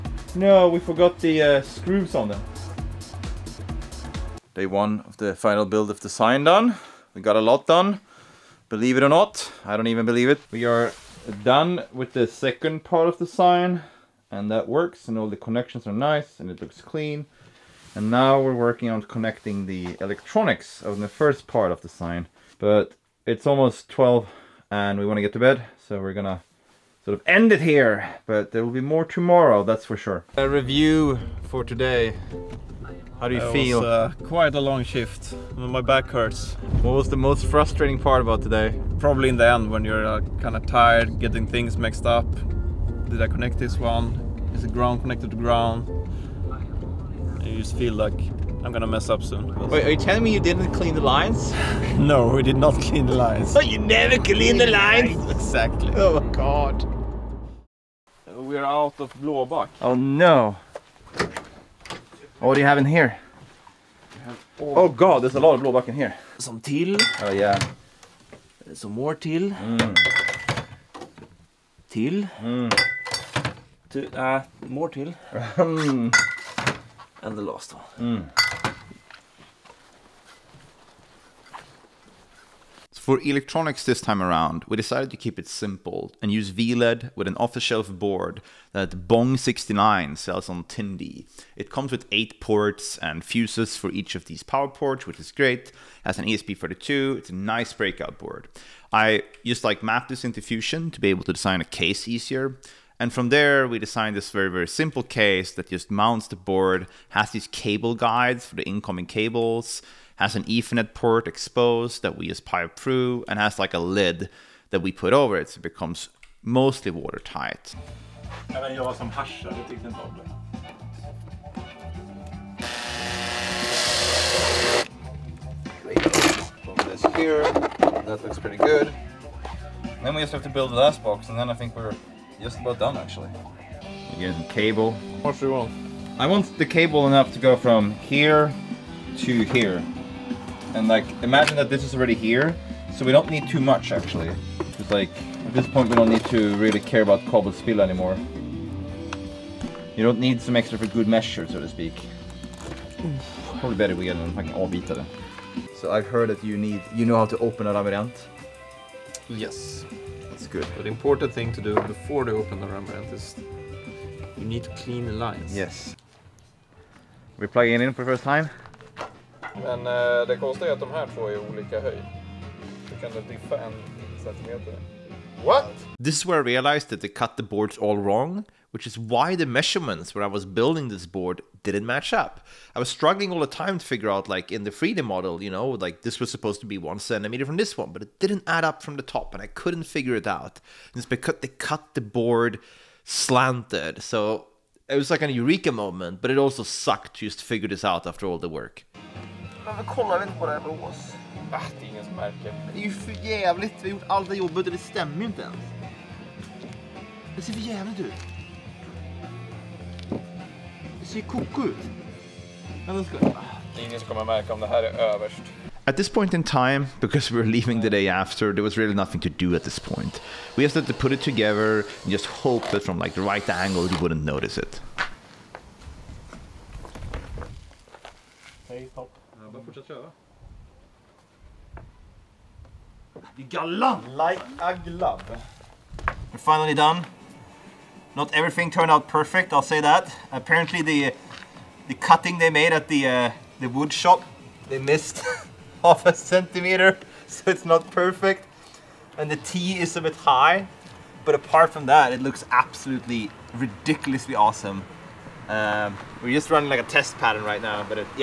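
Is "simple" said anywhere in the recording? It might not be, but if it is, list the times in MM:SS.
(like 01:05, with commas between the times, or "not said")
01:25, 01:44.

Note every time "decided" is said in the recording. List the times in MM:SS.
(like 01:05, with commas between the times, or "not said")
01:24.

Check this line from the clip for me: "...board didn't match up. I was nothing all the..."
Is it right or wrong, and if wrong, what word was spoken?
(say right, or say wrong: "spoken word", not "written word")
wrong: "struggling", not "nothing".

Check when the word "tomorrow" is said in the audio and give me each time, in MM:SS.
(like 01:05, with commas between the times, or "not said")
00:29.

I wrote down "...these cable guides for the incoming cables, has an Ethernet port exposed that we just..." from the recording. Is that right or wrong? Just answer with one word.
right.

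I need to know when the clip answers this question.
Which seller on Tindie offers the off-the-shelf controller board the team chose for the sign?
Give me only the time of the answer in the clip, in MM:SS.
01:29.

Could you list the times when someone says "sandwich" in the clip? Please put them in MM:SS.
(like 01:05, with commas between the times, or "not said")
not said.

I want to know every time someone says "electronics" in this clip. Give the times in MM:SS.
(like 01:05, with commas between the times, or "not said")
00:20, 01:23.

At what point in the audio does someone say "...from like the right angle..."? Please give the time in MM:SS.
03:42.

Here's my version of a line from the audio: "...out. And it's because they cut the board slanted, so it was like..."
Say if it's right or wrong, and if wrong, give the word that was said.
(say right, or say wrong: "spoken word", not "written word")
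right.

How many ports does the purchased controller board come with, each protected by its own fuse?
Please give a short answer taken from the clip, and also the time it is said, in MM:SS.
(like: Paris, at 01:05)
8, at 01:32.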